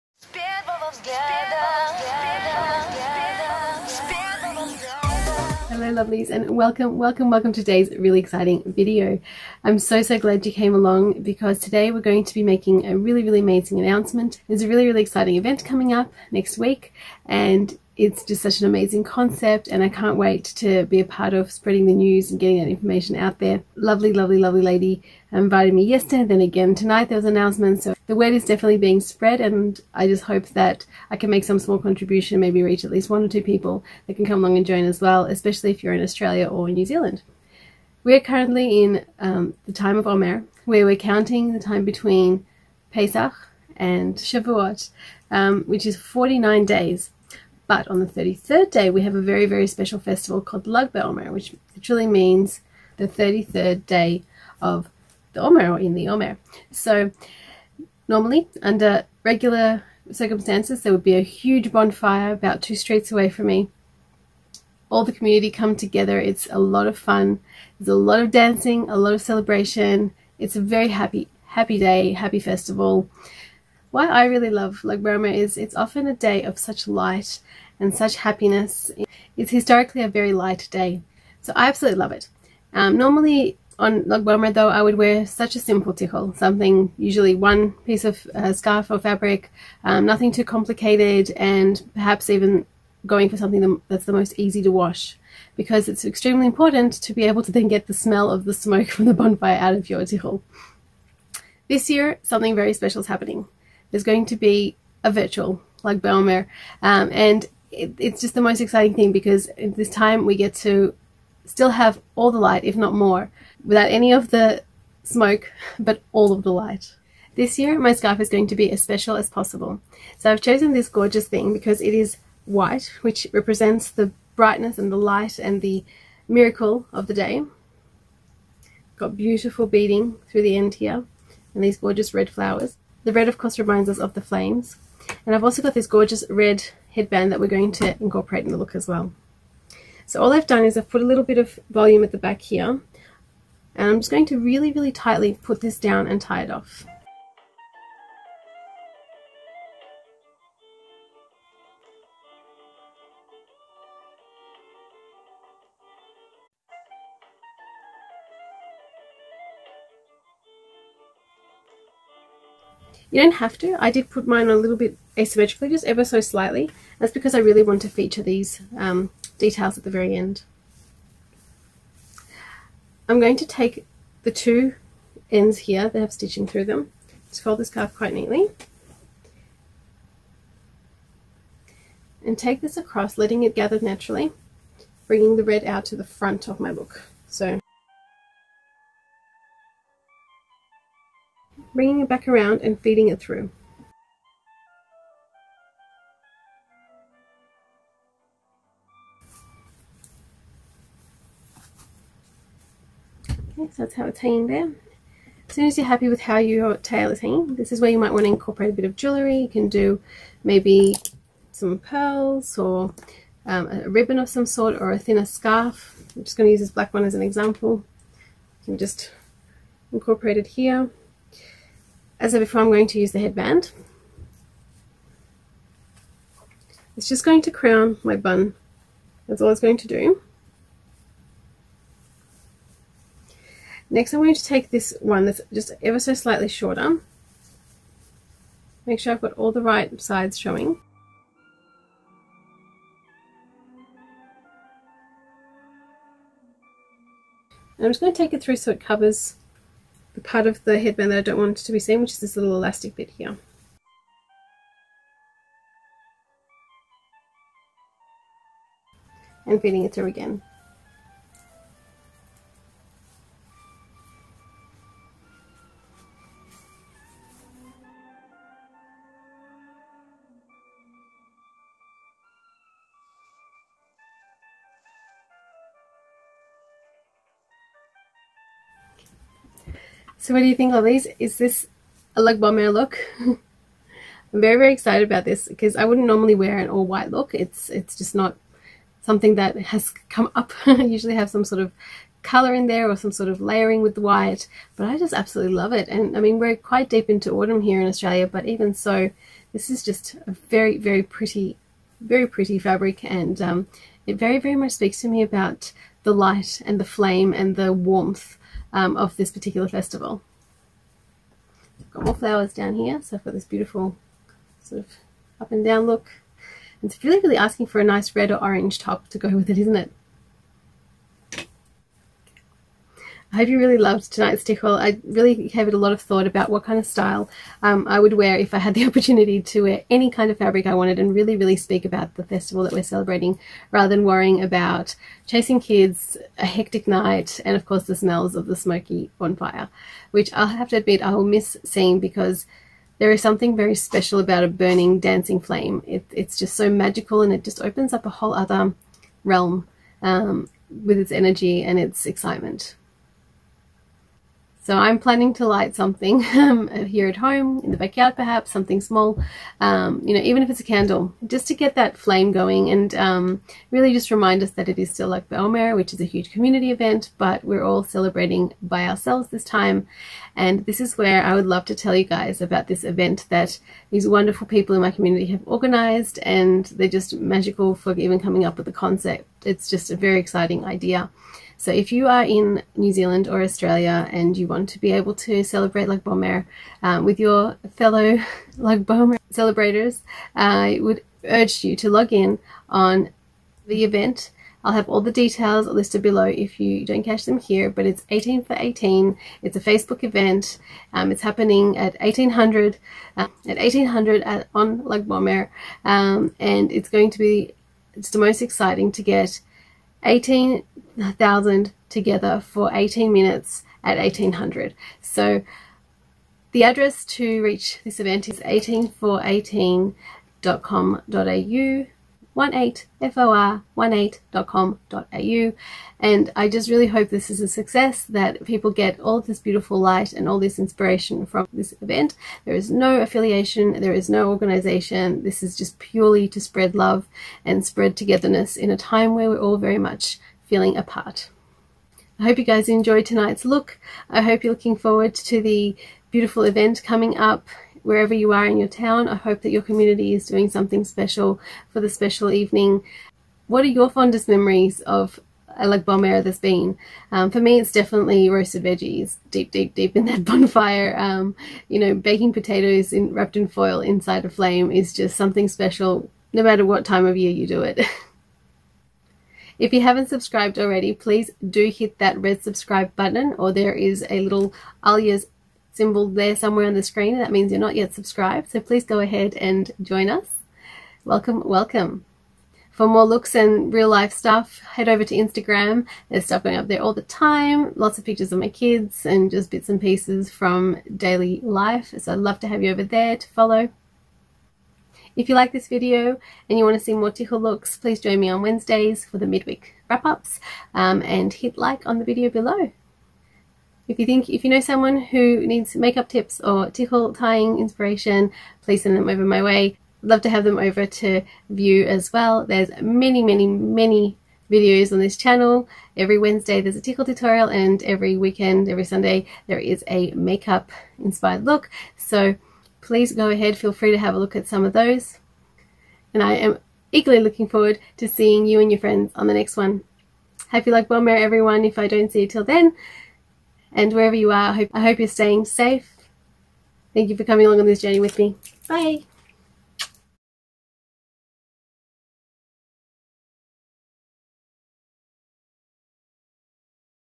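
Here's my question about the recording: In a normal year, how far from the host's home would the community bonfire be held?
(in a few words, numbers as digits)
Two streets.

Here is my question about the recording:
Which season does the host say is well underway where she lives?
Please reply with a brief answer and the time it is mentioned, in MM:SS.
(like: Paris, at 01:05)
Autumn, at 04:57.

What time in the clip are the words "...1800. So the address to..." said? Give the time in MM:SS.
06:53.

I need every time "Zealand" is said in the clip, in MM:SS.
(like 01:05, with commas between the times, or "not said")
00:36, 06:22.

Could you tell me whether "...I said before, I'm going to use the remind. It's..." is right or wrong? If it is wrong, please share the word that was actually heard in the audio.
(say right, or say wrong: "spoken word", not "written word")
wrong: "headband", not "remind".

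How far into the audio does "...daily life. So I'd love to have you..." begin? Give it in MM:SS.
08:10.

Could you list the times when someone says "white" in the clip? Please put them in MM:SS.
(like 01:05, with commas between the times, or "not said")
02:02, 04:46, 04:54.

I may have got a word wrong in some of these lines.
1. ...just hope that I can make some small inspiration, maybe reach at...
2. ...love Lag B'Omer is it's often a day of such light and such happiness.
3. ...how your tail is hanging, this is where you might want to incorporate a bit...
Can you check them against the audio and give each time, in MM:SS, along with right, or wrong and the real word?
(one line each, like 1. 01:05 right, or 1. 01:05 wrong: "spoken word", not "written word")
1. 00:30 wrong: "contribution", not "inspiration"
2. 01:14 right
3. 03:26 right.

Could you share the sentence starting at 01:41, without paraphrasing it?
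This year, something very special is happening.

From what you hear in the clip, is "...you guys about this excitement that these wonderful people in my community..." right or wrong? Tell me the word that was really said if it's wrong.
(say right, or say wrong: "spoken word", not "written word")
wrong: "event", not "excitement".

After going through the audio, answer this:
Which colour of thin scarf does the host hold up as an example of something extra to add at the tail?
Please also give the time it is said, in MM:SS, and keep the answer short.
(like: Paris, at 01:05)
Black, at 03:36.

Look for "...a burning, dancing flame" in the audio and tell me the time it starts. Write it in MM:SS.
05:44.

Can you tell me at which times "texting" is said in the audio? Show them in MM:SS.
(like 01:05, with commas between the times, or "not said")
not said.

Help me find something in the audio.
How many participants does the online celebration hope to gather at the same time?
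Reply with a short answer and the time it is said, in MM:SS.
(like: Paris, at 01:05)
18,000, at 06:50.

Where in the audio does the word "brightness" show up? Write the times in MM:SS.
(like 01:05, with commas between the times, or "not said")
02:04.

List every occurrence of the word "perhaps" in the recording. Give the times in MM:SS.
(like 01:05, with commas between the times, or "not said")
01:31, 05:58.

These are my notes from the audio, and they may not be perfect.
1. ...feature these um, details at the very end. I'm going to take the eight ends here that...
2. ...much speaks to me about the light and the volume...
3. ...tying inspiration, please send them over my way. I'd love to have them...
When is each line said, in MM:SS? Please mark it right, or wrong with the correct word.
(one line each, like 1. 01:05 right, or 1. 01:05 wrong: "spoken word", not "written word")
1. 02:47 wrong: "two", not "eight"
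2. 05:04 wrong: "flame", not "volume"
3. 08:27 right.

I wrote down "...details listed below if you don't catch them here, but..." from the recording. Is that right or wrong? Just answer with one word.
right.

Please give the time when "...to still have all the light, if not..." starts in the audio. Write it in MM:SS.
01:50.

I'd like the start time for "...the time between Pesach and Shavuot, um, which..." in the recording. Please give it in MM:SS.
00:41.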